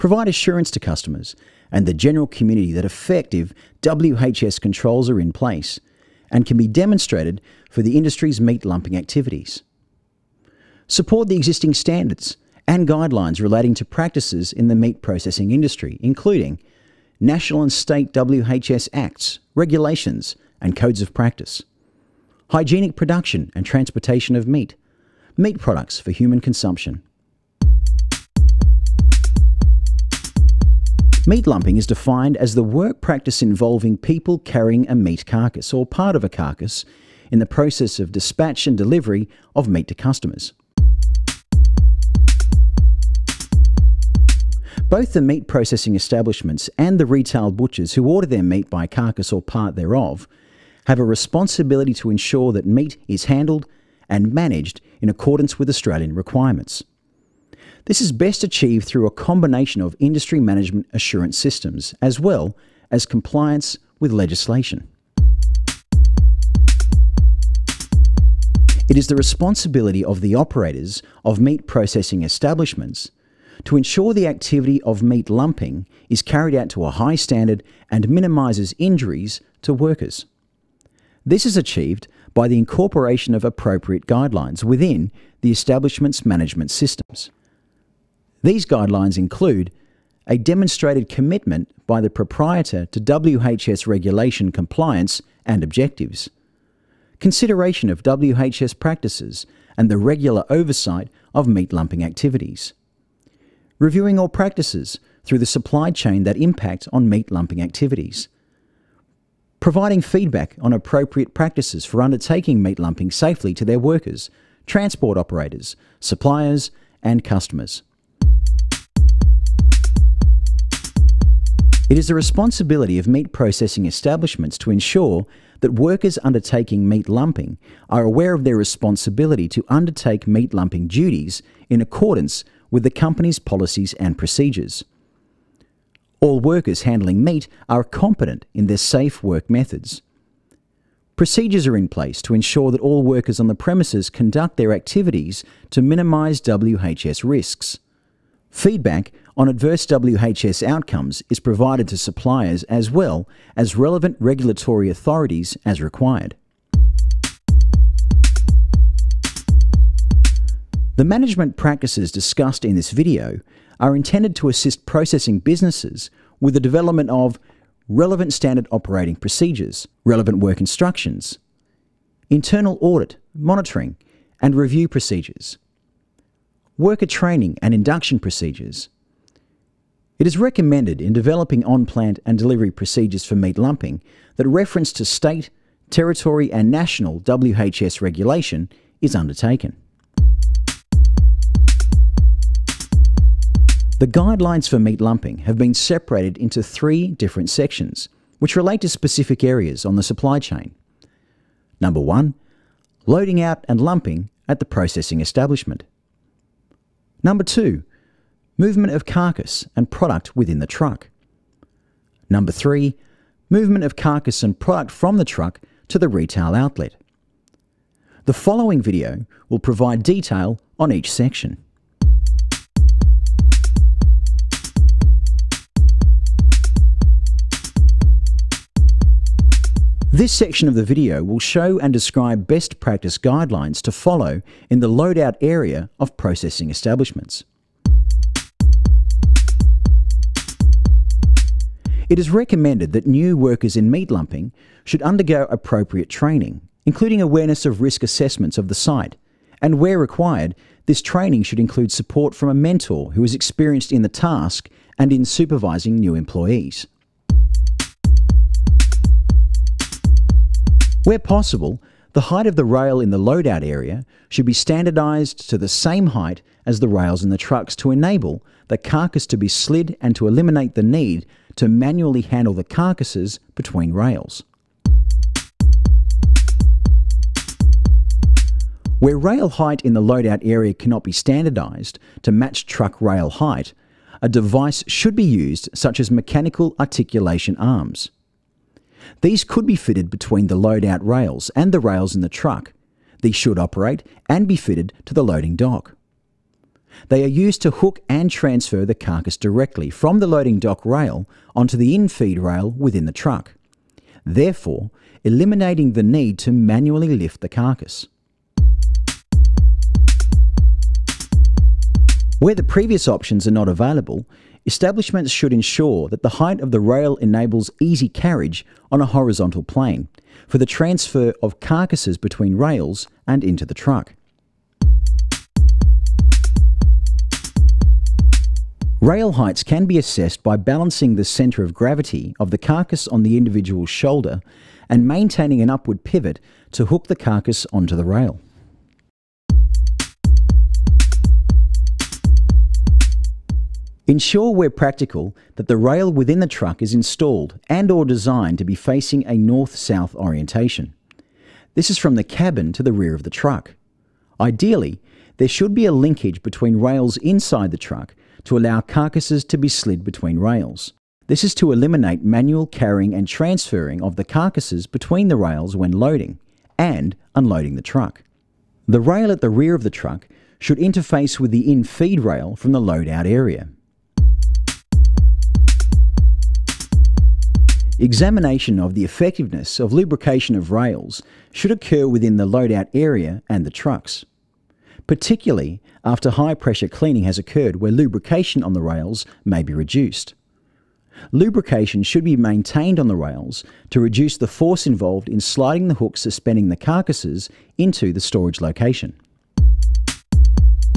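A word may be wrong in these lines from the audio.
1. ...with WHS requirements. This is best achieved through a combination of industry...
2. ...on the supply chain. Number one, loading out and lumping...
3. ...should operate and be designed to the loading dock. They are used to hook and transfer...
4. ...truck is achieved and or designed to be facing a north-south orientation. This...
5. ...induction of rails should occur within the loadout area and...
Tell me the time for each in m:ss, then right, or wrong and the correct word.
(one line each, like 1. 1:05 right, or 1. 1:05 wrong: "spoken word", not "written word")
1. 0:55 wrong: "Australian", not "WHS"
2. 3:19 right
3. 4:53 wrong: "fitted", not "designed"
4. 5:46 wrong: "installed", not "achieved"
5. 6:19 wrong: "lubrication", not "induction".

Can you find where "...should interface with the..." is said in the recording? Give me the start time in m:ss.
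6:10.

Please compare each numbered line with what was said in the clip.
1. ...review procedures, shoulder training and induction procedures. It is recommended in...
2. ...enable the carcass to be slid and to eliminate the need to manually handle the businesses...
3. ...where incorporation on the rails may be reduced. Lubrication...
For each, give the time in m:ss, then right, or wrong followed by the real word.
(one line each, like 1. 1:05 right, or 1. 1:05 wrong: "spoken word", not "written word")
1. 2:54 wrong: "worker", not "shoulder"
2. 4:27 wrong: "carcasses", not "businesses"
3. 6:27 wrong: "lubrication", not "incorporation".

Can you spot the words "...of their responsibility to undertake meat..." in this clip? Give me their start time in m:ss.
2:08.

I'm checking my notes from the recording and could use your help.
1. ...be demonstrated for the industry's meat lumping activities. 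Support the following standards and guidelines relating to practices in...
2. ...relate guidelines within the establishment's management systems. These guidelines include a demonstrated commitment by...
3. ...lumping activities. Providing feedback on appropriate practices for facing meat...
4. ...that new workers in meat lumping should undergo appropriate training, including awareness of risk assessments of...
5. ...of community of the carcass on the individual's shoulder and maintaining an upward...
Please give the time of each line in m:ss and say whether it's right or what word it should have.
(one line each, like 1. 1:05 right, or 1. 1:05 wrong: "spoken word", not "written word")
1. 0:06 wrong: "existing", not "following"
2. 1:23 wrong: "appropriate", not "relate"
3. 1:47 wrong: "undertaking", not "facing"
4. 4:02 right
5. 5:31 wrong: "gravity", not "community".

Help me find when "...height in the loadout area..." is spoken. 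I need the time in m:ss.
4:39.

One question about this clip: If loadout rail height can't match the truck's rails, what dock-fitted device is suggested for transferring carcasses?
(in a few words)
Mechanical articulation arms.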